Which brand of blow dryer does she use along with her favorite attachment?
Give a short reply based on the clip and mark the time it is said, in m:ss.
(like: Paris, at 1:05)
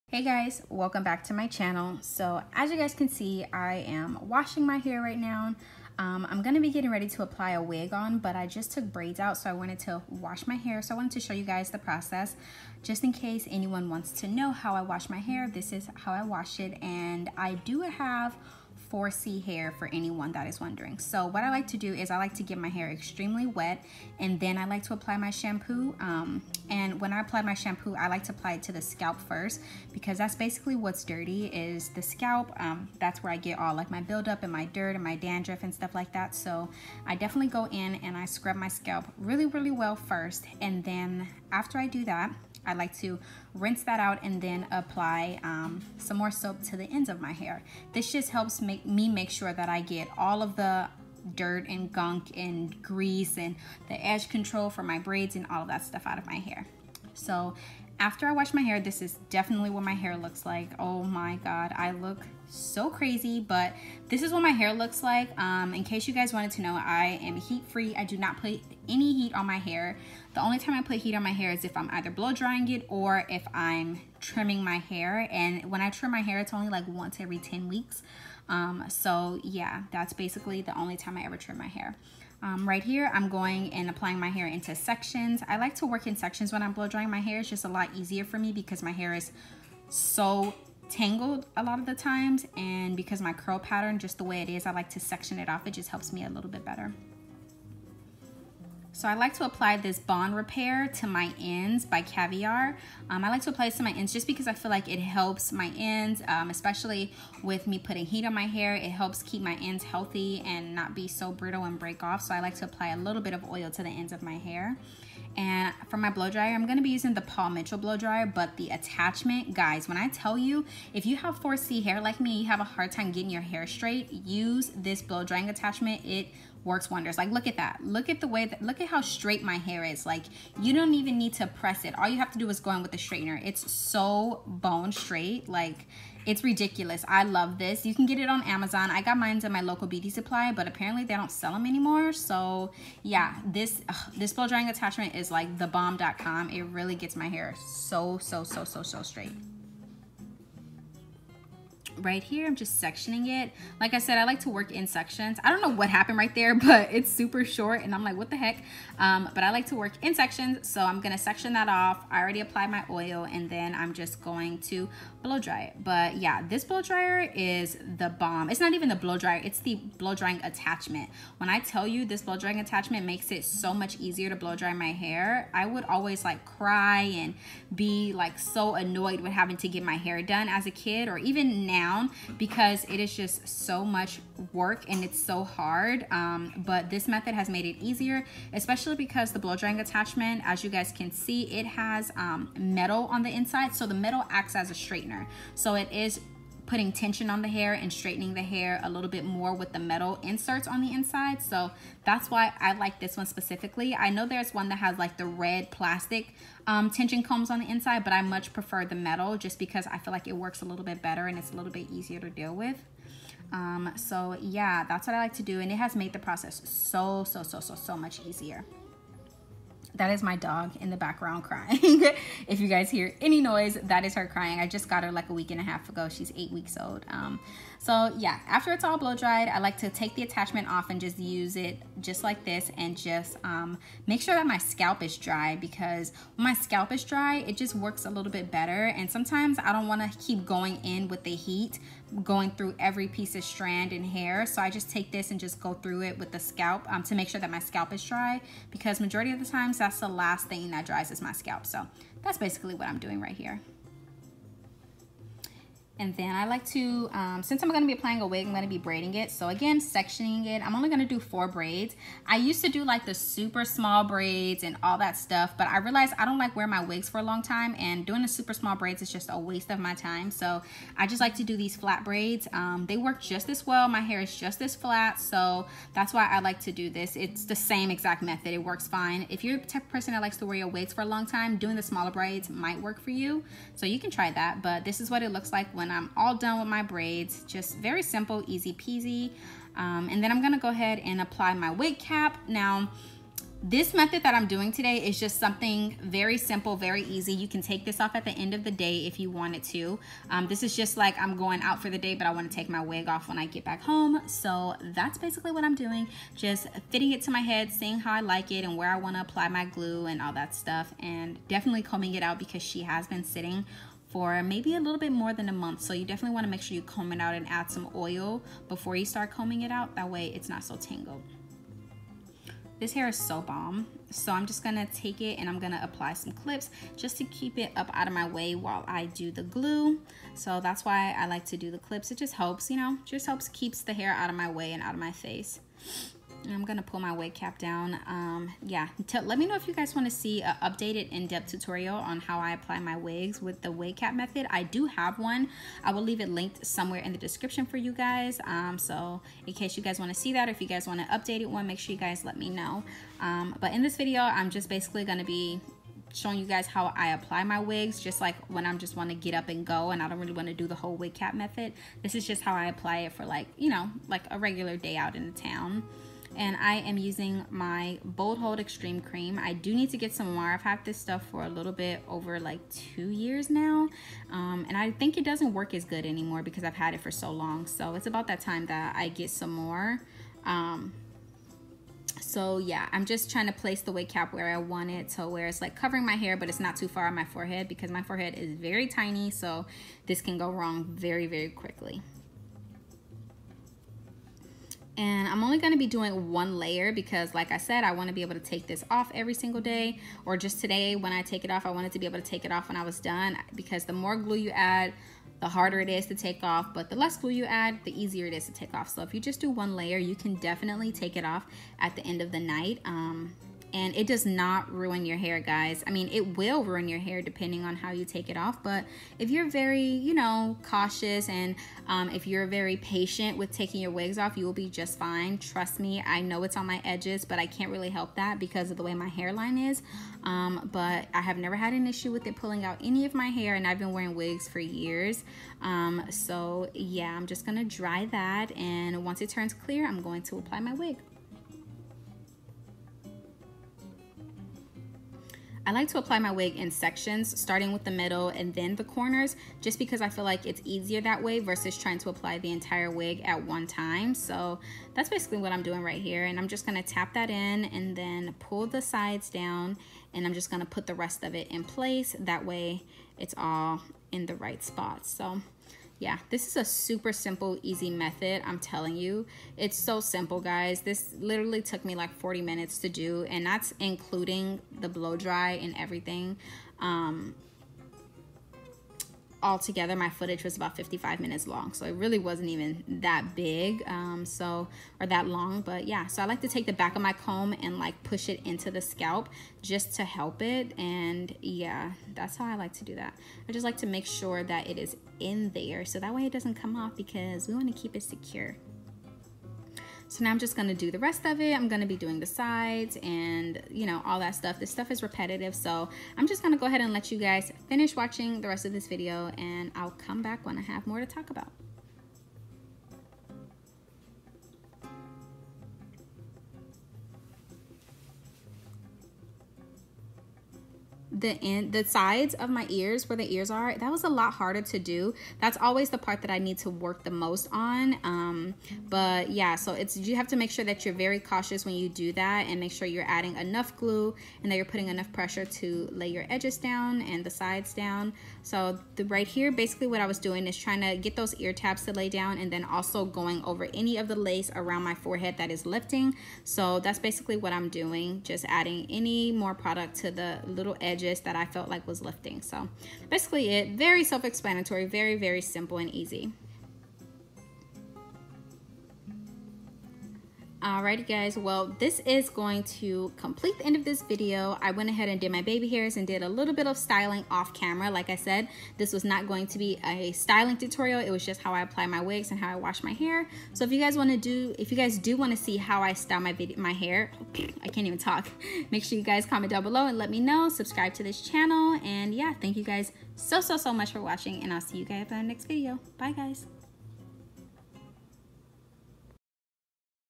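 Paul Mitchell, at 1:57.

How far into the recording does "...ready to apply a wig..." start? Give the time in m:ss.
0:06.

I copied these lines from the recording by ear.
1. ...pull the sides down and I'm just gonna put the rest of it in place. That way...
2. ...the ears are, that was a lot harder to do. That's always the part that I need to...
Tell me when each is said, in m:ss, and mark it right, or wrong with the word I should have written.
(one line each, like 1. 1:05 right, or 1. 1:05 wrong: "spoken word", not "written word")
1. 7:38 right
2. 8:43 right.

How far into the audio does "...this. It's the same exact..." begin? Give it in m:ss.
4:36.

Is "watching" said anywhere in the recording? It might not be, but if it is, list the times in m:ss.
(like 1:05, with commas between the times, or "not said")
8:27, 9:44.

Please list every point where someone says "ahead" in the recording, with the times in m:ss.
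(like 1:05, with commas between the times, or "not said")
4:50, 8:26, 9:24.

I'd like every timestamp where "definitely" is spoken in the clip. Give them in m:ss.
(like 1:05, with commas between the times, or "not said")
0:37, 0:59, 5:11, 5:16, 6:50.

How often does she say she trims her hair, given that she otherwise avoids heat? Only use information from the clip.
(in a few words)
Once every 10 weeks.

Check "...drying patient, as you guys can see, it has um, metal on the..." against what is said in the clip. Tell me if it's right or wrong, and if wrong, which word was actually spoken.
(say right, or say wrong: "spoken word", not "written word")
wrong: "attachment", not "patient".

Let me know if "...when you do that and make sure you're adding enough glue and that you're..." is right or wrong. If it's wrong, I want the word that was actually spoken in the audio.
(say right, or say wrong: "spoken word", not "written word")
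right.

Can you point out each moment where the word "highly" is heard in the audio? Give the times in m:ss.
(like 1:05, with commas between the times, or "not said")
not said.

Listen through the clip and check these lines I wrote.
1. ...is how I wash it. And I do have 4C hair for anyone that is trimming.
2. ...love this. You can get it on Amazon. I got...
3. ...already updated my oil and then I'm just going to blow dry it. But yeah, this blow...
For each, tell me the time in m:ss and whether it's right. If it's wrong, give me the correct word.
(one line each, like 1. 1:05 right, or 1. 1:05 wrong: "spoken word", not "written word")
1. 0:15 wrong: "wondering", not "trimming"
2. 2:17 right
3. 2:42 wrong: "applied", not "updated".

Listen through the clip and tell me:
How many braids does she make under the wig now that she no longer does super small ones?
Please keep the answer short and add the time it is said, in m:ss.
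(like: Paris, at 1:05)
4, at 4:21.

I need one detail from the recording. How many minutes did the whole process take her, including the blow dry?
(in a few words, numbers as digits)
40 minutes.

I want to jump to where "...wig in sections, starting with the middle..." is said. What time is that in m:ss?
7:26.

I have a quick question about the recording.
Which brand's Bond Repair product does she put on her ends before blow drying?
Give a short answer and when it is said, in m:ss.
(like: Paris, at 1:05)
Caviar, at 1:42.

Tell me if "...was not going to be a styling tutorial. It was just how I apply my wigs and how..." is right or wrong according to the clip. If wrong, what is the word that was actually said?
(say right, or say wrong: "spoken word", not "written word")
right.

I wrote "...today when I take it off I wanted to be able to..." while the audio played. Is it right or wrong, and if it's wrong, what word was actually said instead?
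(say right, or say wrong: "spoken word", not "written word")
right.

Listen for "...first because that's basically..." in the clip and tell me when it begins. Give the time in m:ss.
0:29.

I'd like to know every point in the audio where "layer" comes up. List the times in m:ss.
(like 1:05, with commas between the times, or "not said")
6:36, 6:49.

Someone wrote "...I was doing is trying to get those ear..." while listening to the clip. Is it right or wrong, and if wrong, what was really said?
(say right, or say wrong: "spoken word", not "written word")
right.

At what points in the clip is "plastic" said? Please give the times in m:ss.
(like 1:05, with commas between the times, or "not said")
3:25.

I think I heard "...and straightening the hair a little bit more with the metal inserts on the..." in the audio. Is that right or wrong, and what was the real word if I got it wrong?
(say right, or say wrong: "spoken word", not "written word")
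right.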